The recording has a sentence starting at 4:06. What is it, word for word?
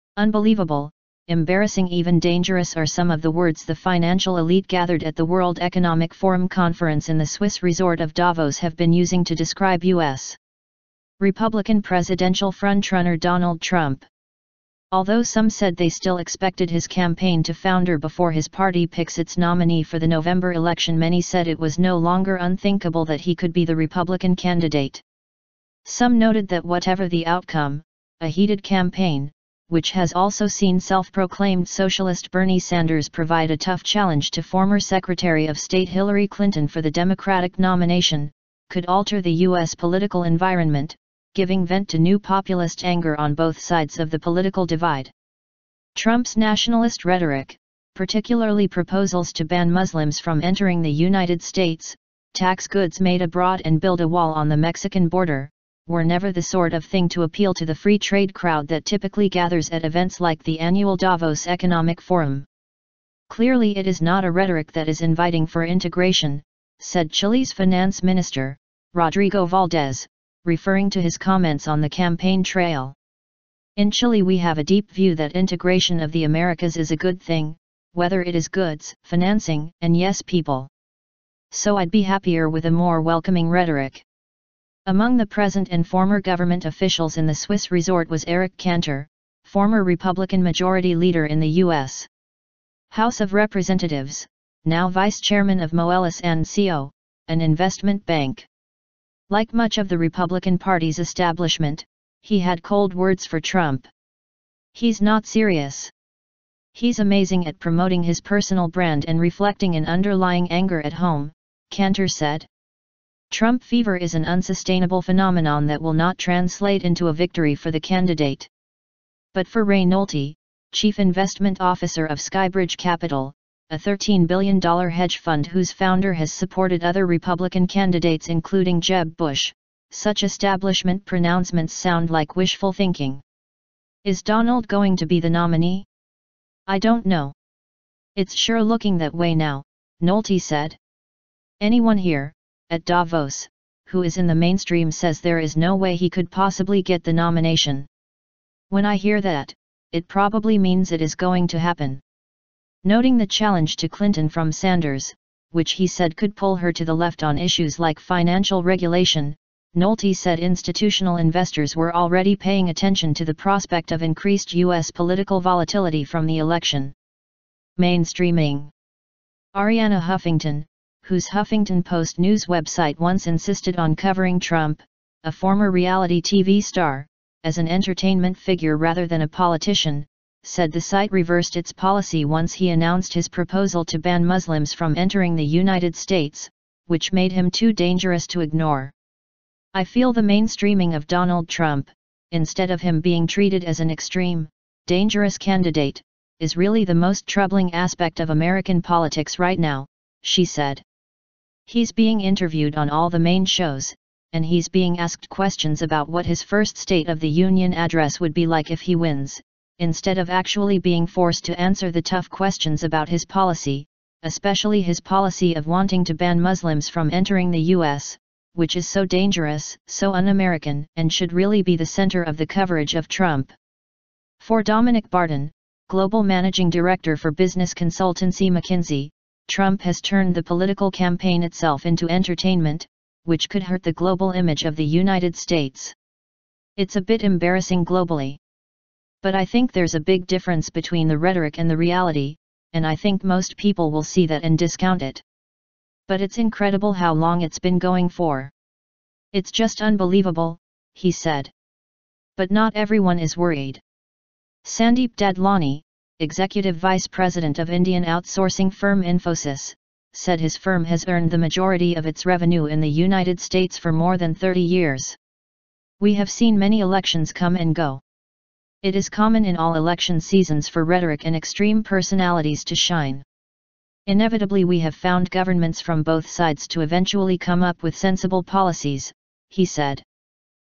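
But it's incredible how long it's been going for.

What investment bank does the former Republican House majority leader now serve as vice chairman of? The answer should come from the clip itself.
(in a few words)
Moelis and Co.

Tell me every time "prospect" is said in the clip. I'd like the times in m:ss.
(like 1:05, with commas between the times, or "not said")
2:43.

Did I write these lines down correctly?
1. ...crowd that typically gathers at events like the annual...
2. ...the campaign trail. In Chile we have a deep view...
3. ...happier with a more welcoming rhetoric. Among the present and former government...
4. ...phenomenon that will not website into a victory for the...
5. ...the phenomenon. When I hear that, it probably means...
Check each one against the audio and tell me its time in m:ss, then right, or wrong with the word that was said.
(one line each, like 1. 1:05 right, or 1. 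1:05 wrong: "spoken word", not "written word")
1. 0:58 right
2. 1:11 right
3. 1:22 right
4. 1:55 wrong: "translate", not "website"
5. 2:27 wrong: "nomination", not "phenomenon".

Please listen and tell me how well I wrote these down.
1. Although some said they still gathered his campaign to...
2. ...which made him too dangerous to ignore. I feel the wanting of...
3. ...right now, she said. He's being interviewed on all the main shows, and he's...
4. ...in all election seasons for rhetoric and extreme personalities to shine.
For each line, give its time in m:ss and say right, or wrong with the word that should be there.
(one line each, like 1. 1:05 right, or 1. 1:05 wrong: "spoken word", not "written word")
1. 0:14 wrong: "expected", not "gathered"
2. 3:06 wrong: "mainstreaming", not "wanting"
3. 3:19 right
4. 4:29 right.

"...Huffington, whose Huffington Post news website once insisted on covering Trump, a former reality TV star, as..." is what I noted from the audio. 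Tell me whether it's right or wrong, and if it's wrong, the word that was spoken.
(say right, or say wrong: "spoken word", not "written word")
right.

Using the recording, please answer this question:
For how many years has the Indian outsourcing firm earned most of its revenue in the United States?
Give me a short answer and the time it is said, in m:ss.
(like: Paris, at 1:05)
more than 30 years, at 4:23.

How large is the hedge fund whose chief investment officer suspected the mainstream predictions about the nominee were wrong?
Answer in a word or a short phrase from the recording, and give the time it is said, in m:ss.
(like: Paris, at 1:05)
$13 billion, at 2:03.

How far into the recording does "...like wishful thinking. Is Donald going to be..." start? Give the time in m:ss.
2:12.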